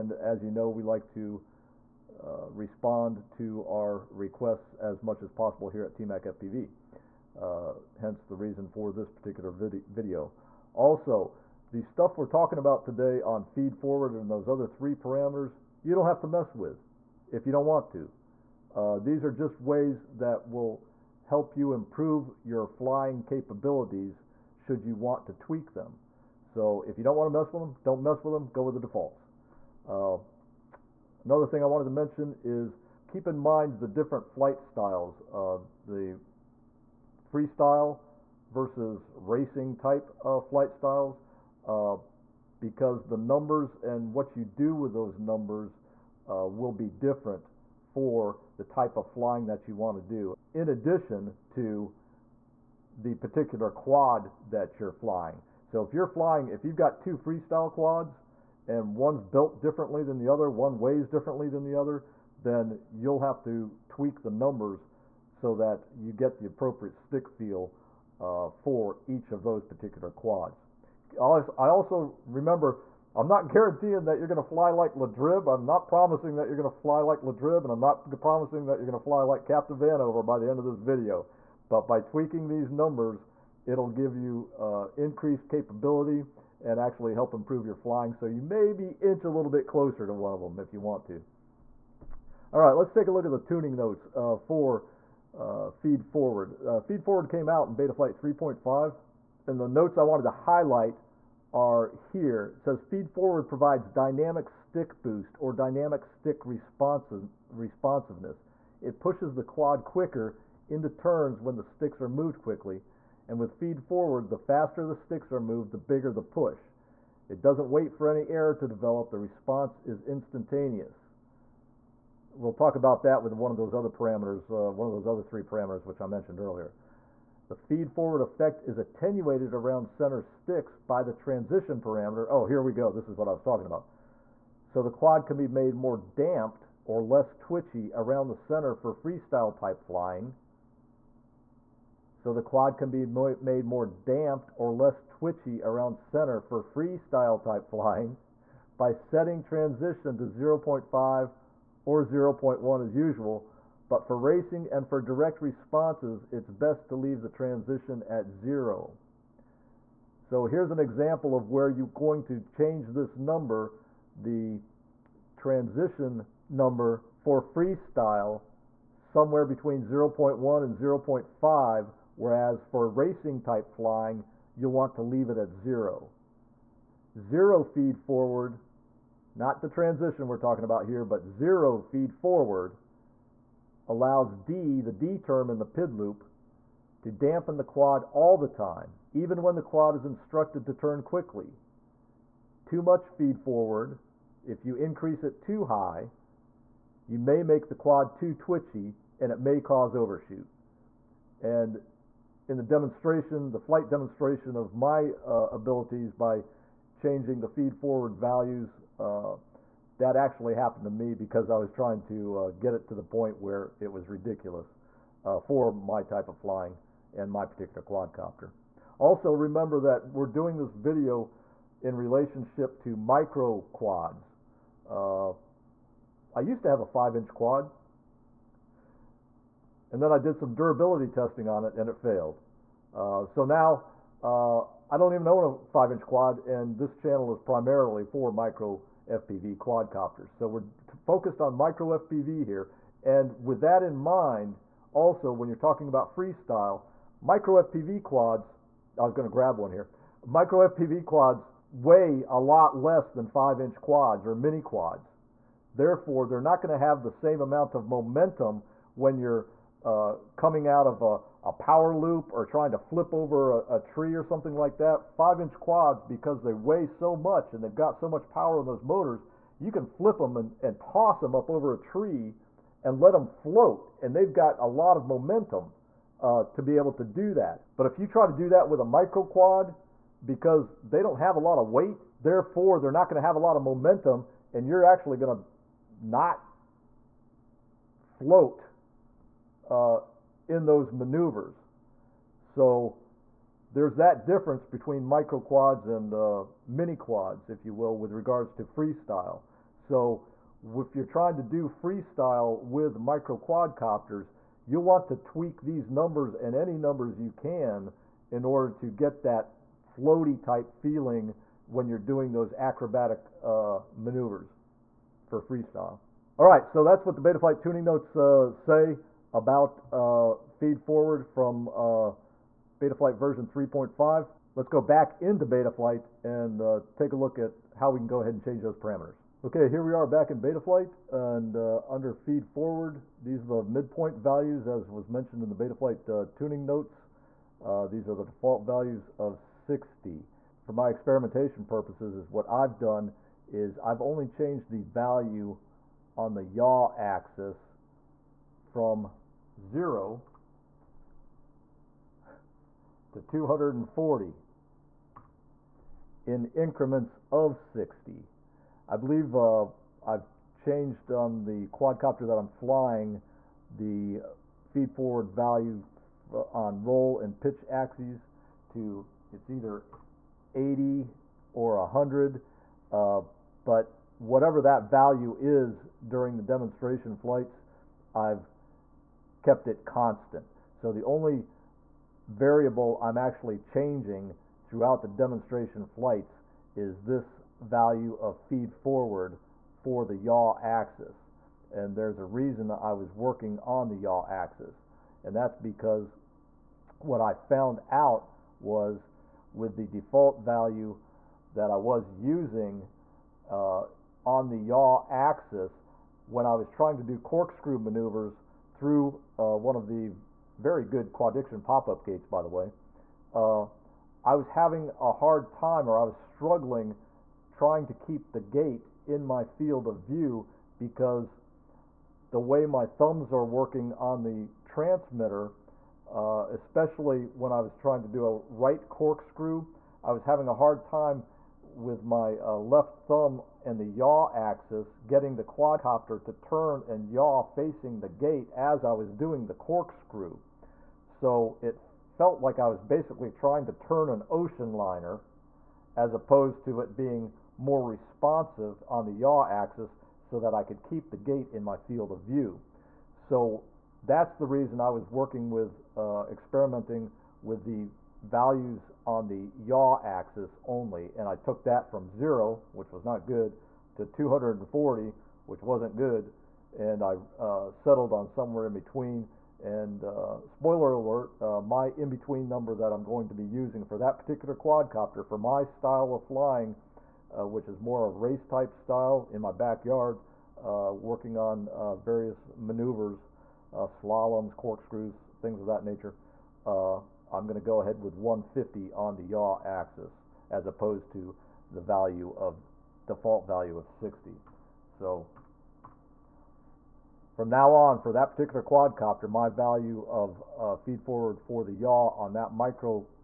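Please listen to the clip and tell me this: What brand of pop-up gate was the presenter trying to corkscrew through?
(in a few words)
Quadiction.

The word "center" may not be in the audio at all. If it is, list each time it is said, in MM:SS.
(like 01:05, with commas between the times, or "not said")
02:09, 02:18, 02:25.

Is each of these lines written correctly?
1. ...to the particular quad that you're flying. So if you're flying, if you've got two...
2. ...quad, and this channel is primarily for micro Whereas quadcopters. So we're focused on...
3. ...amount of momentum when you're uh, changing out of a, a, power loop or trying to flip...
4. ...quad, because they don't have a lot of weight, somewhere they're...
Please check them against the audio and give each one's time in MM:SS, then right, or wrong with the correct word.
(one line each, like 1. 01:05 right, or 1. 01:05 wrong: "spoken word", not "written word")
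1. 00:51 right
2. 03:56 wrong: "FPV", not "Whereas"
3. 04:17 wrong: "coming", not "changing"
4. 04:39 wrong: "therefore", not "somewhere".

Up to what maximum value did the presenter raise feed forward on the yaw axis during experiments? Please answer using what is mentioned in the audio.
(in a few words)
240.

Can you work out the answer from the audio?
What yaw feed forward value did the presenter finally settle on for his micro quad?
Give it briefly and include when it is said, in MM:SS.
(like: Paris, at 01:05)
150, at 08:08.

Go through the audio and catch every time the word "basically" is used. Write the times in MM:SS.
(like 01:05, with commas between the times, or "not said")
07:22.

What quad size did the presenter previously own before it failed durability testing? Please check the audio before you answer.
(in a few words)
5 inch.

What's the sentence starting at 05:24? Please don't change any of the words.
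Let's go back into Betaflight and uh, take a look at how we can go ahead and change those parameters.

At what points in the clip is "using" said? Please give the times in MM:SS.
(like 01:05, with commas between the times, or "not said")
06:42, 07:53.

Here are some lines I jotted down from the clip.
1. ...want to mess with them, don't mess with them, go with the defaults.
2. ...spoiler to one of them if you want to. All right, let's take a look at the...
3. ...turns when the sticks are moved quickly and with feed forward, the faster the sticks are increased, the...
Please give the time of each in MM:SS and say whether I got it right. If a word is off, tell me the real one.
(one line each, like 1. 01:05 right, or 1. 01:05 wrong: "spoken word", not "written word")
1. 00:27 right
2. 01:29 wrong: "closer", not "spoiler"
3. 01:50 wrong: "moved", not "increased".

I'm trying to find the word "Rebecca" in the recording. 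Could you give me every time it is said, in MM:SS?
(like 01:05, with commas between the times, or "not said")
not said.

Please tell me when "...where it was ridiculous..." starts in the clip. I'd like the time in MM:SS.
03:33.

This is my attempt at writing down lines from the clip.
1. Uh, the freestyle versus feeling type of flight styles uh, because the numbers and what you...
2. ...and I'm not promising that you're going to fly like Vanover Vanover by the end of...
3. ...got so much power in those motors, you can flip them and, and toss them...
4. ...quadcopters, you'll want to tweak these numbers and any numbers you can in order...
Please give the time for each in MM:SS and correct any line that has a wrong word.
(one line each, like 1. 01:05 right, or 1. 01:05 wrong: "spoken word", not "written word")
1. 00:35 wrong: "racing", not "feeling"
2. 01:17 wrong: "Captain", not "Vanover"
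3. 04:27 right
4. 05:03 right.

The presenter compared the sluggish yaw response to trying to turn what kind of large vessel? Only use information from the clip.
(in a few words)
an ocean liner.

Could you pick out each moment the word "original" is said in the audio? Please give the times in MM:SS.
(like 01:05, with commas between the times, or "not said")
not said.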